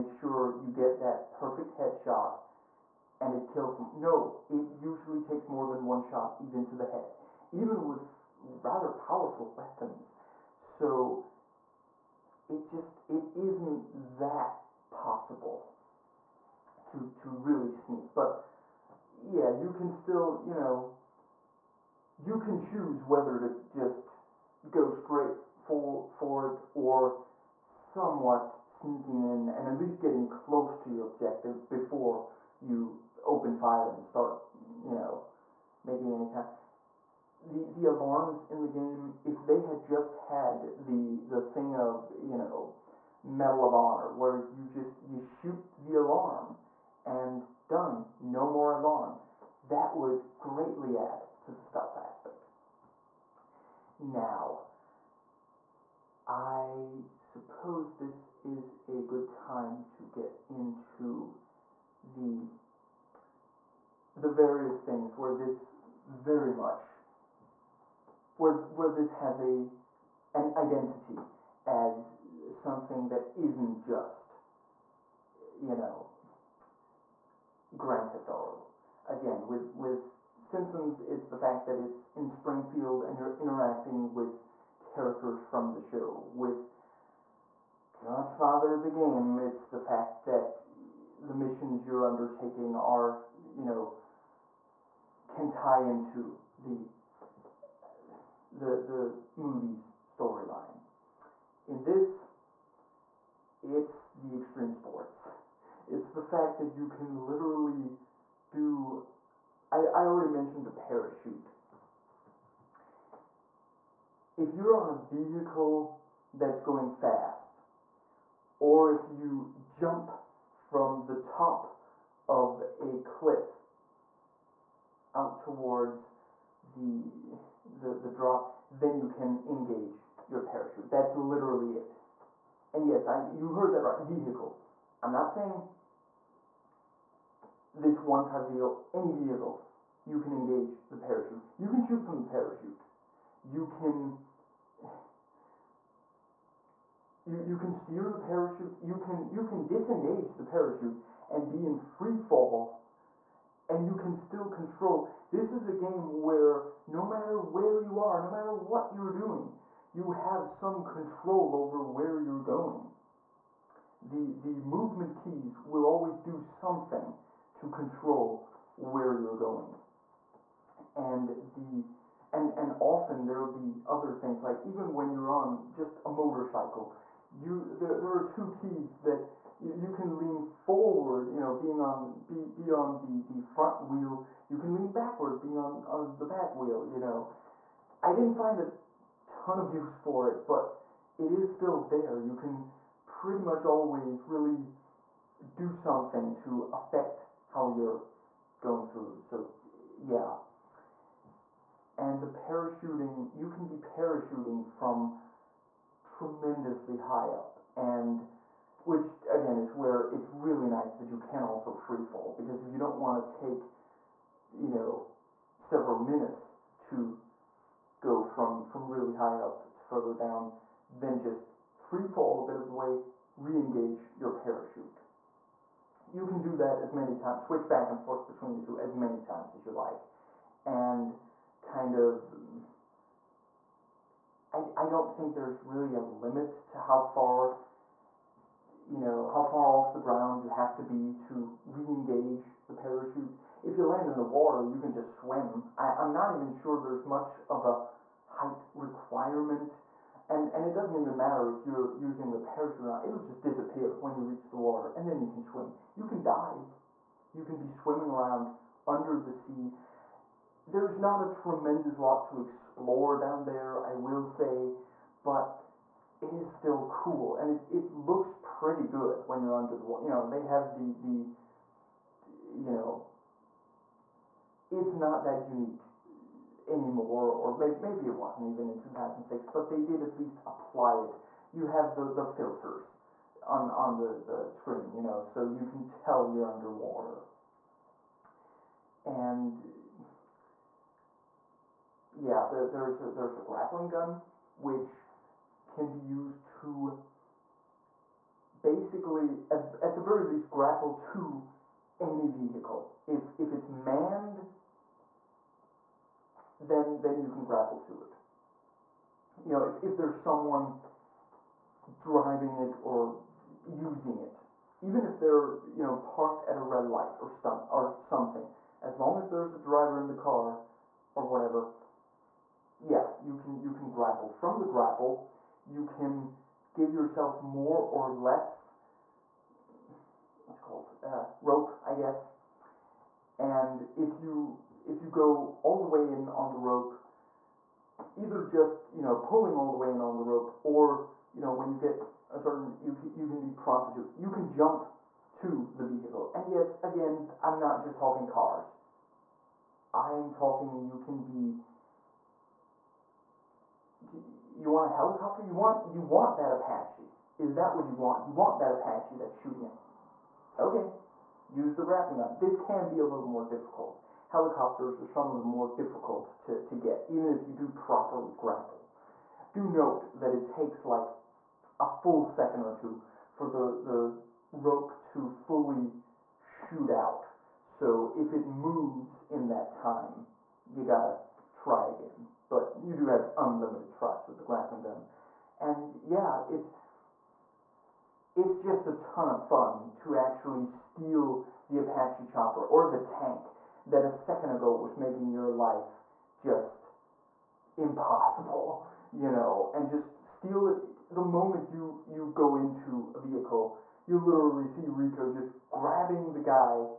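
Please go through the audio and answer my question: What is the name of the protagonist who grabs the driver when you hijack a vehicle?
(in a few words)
Rico.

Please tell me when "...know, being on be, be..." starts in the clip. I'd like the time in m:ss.
3:01.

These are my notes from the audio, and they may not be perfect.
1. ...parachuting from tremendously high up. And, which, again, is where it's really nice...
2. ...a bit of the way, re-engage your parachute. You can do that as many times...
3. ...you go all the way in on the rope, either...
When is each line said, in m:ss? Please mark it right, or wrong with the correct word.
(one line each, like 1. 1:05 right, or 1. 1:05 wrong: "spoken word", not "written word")
1. 3:23 right
2. 3:42 right
3. 5:35 right.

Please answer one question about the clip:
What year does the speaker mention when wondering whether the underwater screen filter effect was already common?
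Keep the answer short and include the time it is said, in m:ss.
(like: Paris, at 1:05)
2006, at 4:38.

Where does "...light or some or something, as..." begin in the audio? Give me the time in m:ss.
5:16.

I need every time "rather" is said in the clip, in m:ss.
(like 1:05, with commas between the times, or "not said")
0:08.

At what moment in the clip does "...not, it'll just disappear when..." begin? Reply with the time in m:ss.
4:12.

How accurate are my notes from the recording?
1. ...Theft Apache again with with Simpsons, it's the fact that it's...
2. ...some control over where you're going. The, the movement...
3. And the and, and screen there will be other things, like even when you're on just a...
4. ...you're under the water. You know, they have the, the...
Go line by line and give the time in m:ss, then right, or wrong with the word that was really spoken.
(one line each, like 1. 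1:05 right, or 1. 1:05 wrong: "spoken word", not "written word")
1. 1:18 wrong: "Auto", not "Apache"
2. 2:40 right
3. 2:50 wrong: "often", not "screen"
4. 4:29 right.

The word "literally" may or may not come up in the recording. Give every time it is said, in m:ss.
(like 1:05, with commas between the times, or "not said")
1:47, 2:11, 6:44.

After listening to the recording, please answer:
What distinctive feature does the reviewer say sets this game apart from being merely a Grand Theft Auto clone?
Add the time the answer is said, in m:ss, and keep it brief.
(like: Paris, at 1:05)
extreme sports, at 1:44.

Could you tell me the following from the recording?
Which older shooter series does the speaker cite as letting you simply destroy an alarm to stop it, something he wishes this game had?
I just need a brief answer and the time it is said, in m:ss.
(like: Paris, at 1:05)
Medal of Honor, at 0:43.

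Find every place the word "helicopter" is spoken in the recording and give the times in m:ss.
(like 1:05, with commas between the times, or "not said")
5:54, 6:04.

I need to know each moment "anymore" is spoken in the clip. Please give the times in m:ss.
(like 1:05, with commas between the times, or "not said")
4:36.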